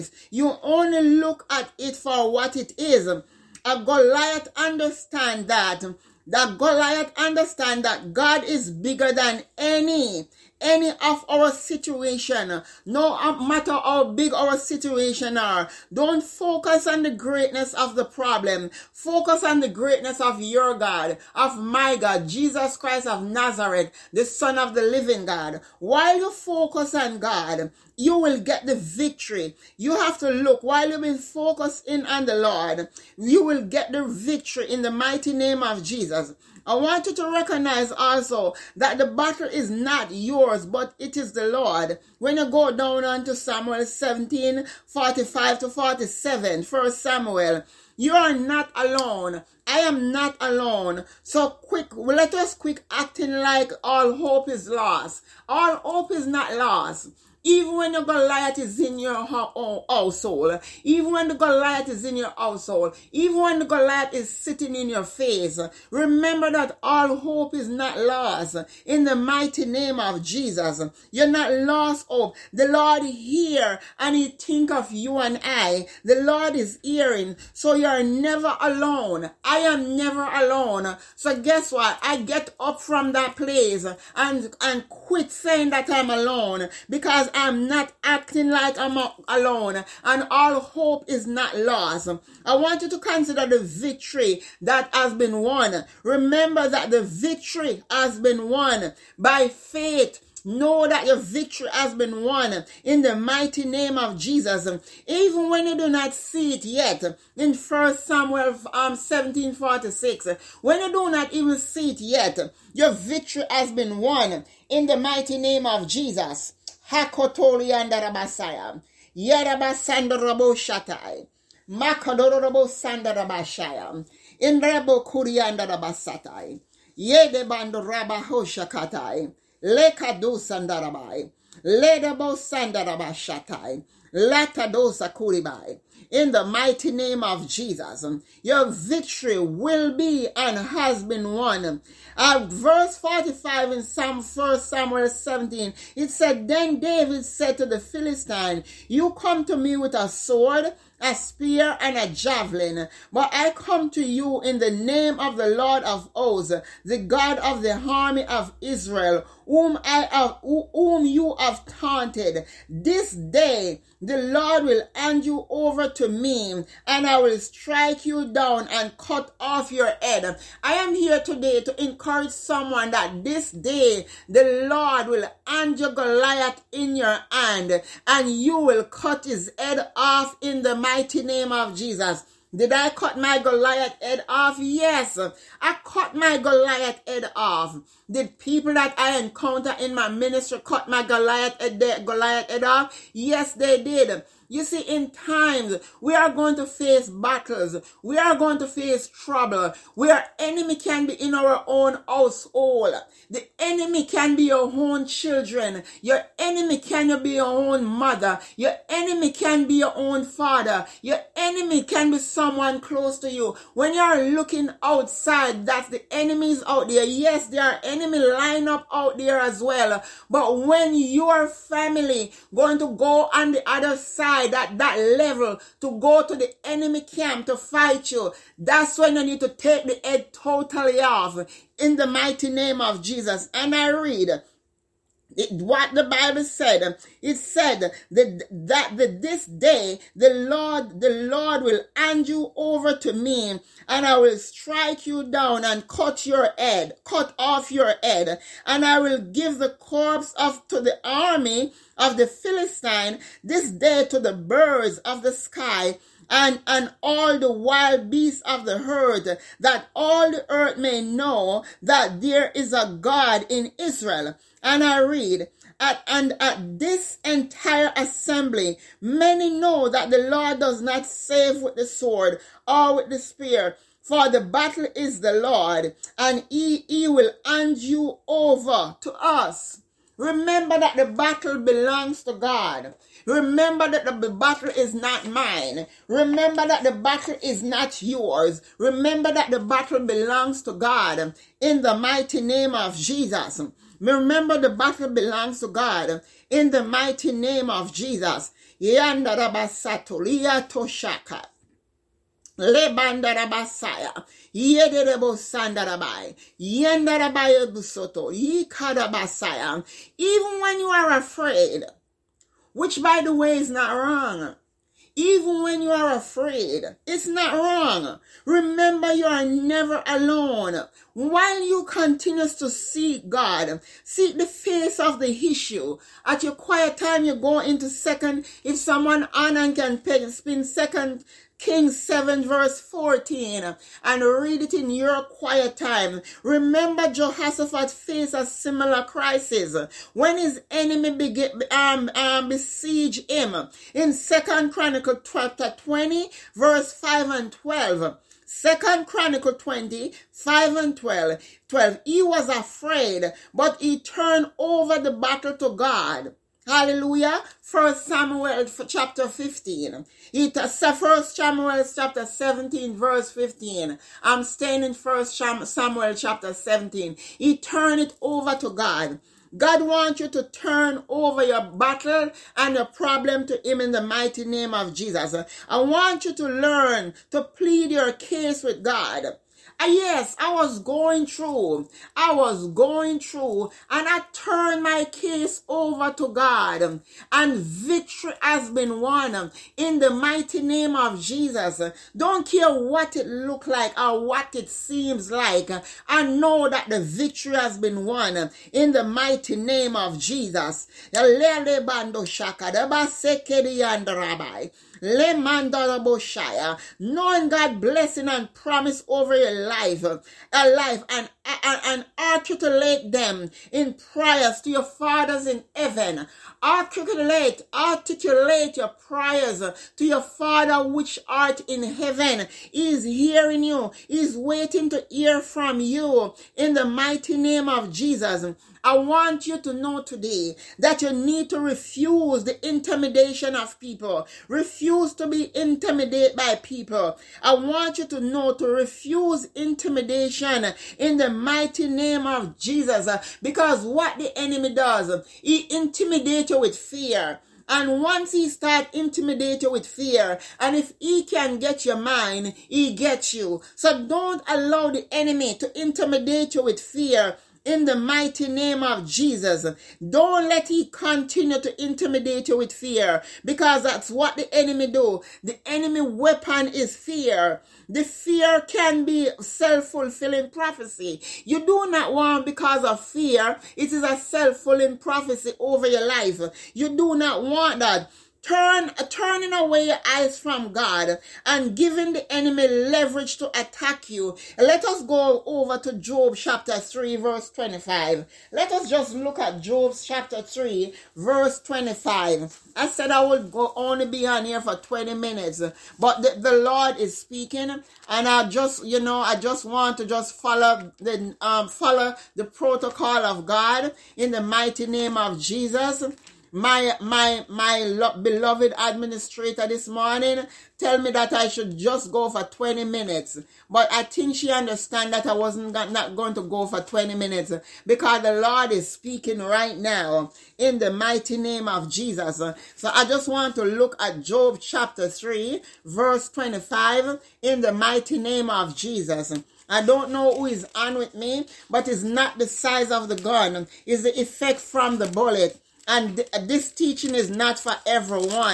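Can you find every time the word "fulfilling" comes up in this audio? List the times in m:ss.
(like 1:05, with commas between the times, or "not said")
7:49, 7:54.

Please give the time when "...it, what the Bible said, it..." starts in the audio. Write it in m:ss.
3:55.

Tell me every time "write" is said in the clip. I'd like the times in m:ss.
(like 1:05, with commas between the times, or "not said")
not said.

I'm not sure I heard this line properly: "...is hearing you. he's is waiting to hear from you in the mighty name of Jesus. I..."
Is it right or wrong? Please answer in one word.
right.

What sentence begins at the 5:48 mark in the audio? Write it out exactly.
Second Chronicle 20, 5 and 12.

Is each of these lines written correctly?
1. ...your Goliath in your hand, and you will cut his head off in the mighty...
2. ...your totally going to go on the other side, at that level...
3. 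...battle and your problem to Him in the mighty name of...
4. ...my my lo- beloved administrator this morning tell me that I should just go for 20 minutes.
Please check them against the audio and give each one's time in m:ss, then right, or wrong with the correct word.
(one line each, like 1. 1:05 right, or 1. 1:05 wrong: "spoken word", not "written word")
1. 2:55 right
2. 3:40 wrong: "family", not "totally"
3. 6:11 right
4. 8:27 right.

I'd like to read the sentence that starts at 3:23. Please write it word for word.
The enemy can be your own children.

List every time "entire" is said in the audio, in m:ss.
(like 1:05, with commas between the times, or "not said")
4:27.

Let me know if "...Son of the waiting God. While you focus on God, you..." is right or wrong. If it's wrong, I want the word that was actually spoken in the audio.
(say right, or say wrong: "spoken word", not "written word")
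wrong: "living", not "waiting".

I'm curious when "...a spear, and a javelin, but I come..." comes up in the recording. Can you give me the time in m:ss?
2:31.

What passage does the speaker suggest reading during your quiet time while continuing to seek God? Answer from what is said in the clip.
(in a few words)
2 Kings 7:14.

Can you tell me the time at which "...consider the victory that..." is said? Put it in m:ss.
1:32.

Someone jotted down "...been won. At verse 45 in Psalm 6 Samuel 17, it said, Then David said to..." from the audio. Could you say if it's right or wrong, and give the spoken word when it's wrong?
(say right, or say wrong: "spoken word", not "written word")
wrong: "1", not "6".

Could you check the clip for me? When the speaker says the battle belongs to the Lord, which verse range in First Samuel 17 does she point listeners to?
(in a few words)
45 to 47.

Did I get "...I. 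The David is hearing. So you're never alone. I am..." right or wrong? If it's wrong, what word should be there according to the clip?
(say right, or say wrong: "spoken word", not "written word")
wrong: "Lord", not "David".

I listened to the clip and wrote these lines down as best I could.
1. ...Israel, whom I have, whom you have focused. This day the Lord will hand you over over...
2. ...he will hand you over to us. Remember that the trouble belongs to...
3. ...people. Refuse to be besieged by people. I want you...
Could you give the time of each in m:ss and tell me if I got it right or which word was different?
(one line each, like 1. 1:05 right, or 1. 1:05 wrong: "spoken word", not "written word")
1. 2:38 wrong: "taunted", not "focused"
2. 4:36 wrong: "battle", not "trouble"
3. 7:13 wrong: "intimidated", not "besieged".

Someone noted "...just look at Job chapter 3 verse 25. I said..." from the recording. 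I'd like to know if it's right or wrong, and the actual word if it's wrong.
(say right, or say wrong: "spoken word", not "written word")
right.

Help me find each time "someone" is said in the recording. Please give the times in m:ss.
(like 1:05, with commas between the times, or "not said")
2:52, 3:32, 5:28.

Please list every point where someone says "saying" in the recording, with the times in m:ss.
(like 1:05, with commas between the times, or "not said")
1:25.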